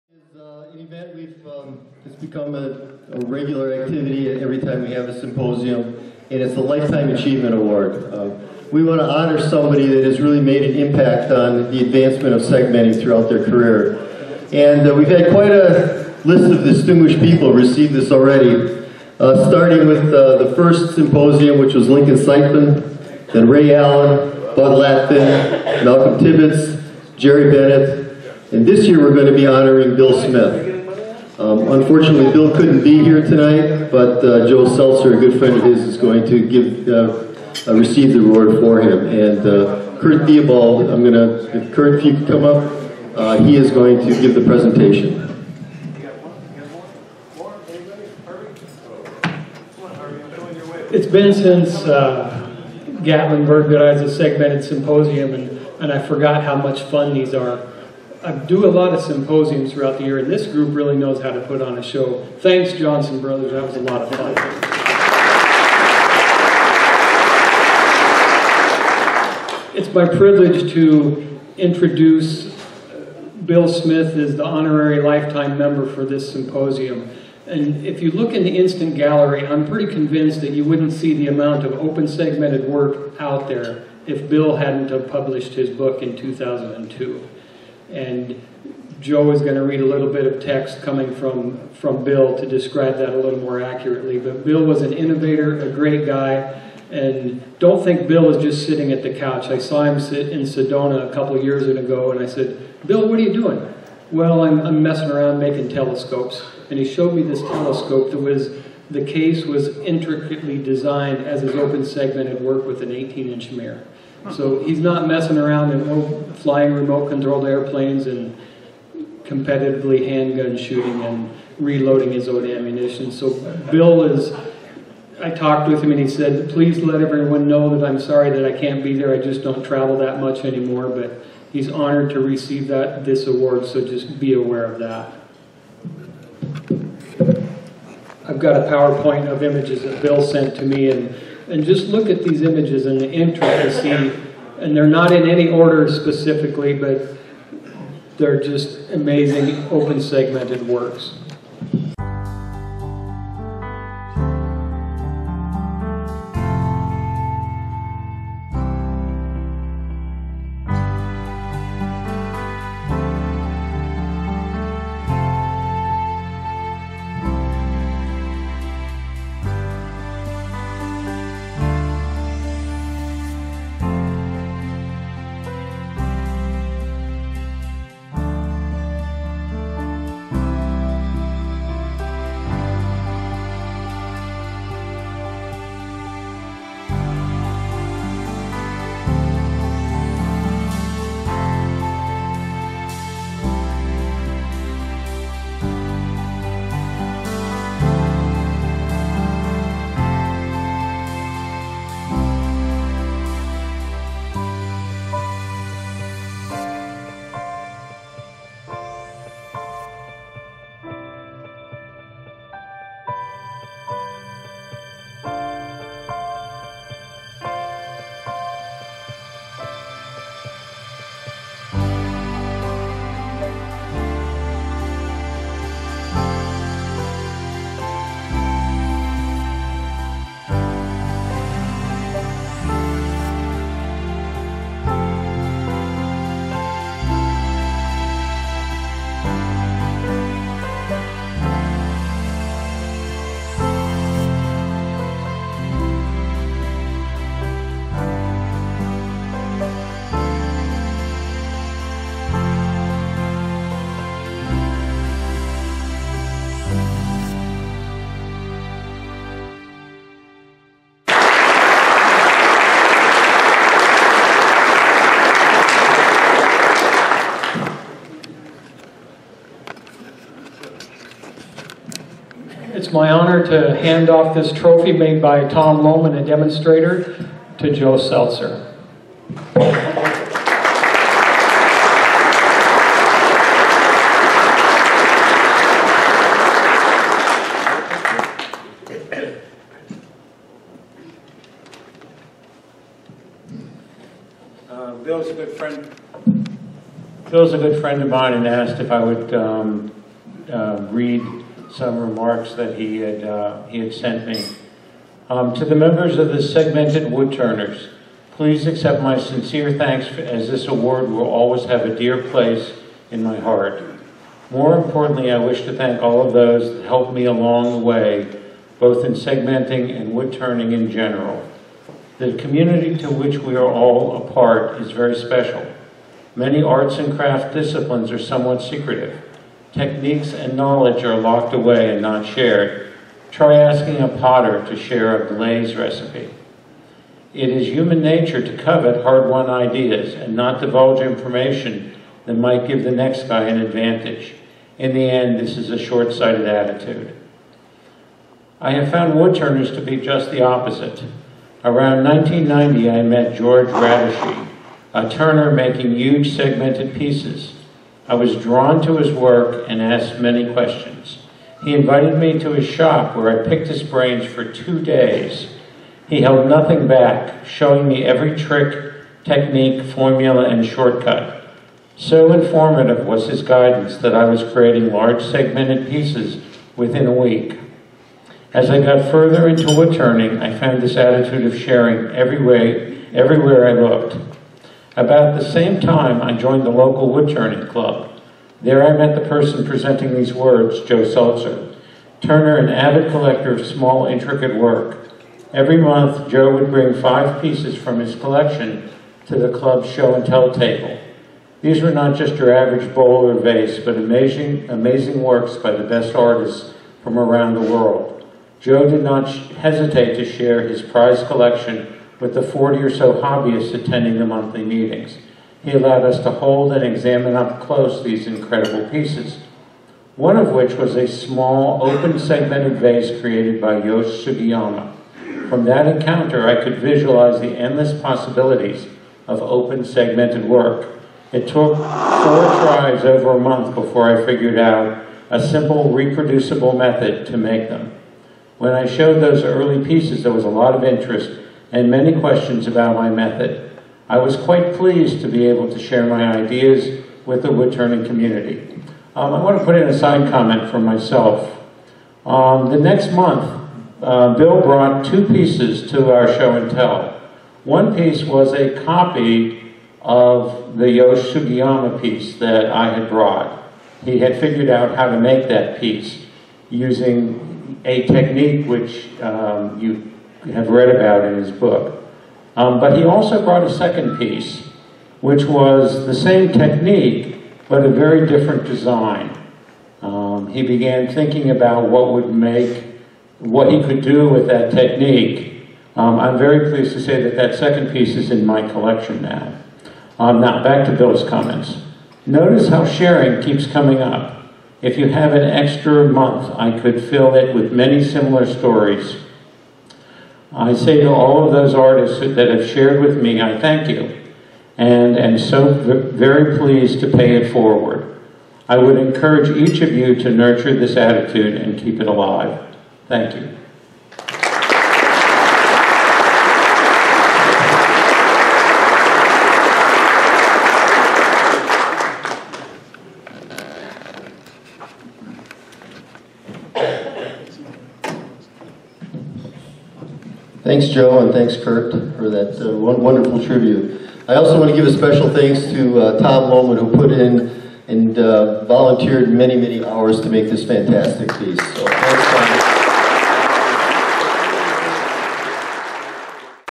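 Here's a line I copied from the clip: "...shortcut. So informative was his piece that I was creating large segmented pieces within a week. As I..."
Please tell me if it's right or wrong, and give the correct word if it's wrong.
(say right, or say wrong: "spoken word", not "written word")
wrong: "guidance", not "piece".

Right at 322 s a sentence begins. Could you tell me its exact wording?
The community to which we are all a part is very special.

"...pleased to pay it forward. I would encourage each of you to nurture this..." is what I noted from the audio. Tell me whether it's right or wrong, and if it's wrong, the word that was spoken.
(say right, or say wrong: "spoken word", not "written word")
right.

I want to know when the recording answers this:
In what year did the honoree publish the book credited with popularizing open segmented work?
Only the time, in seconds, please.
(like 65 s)
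86 s.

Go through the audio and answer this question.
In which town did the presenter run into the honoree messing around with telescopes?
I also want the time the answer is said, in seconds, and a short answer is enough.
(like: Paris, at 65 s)
Sedona, at 100 s.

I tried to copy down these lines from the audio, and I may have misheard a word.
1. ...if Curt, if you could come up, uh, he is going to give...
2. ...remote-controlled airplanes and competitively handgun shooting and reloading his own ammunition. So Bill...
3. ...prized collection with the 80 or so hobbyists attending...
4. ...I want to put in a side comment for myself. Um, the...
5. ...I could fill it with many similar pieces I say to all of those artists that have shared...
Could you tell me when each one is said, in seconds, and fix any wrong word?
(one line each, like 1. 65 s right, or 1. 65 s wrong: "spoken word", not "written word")
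1. 41 s right
2. 116 s right
3. 410 s wrong: "40", not "80"
4. 449 s right
5. 496 s wrong: "stories", not "pieces".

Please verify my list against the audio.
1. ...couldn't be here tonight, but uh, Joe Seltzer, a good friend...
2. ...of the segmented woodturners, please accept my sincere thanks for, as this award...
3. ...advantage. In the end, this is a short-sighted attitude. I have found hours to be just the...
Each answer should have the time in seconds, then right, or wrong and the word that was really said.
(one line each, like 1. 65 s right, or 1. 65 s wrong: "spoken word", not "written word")
1. 32 s right
2. 306 s right
3. 343 s wrong: "woodturners", not "hours".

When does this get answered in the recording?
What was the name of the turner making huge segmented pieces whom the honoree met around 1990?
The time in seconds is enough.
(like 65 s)
353 s.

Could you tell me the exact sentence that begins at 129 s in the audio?
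I just don't travel that much anymore, but he's honored to receive that this award, so just be aware of that.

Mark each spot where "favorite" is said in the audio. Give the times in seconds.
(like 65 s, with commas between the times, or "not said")
not said.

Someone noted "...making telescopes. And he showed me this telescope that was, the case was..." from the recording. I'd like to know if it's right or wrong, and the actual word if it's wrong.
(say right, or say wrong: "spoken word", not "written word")
right.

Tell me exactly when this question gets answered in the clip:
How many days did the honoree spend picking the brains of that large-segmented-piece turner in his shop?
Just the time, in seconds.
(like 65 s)
364 s.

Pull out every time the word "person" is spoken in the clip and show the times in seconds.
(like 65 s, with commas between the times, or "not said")
389 s.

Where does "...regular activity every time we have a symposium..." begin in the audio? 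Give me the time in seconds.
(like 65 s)
3 s.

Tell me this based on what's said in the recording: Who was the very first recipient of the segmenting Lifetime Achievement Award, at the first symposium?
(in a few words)
Lincoln Seitzman.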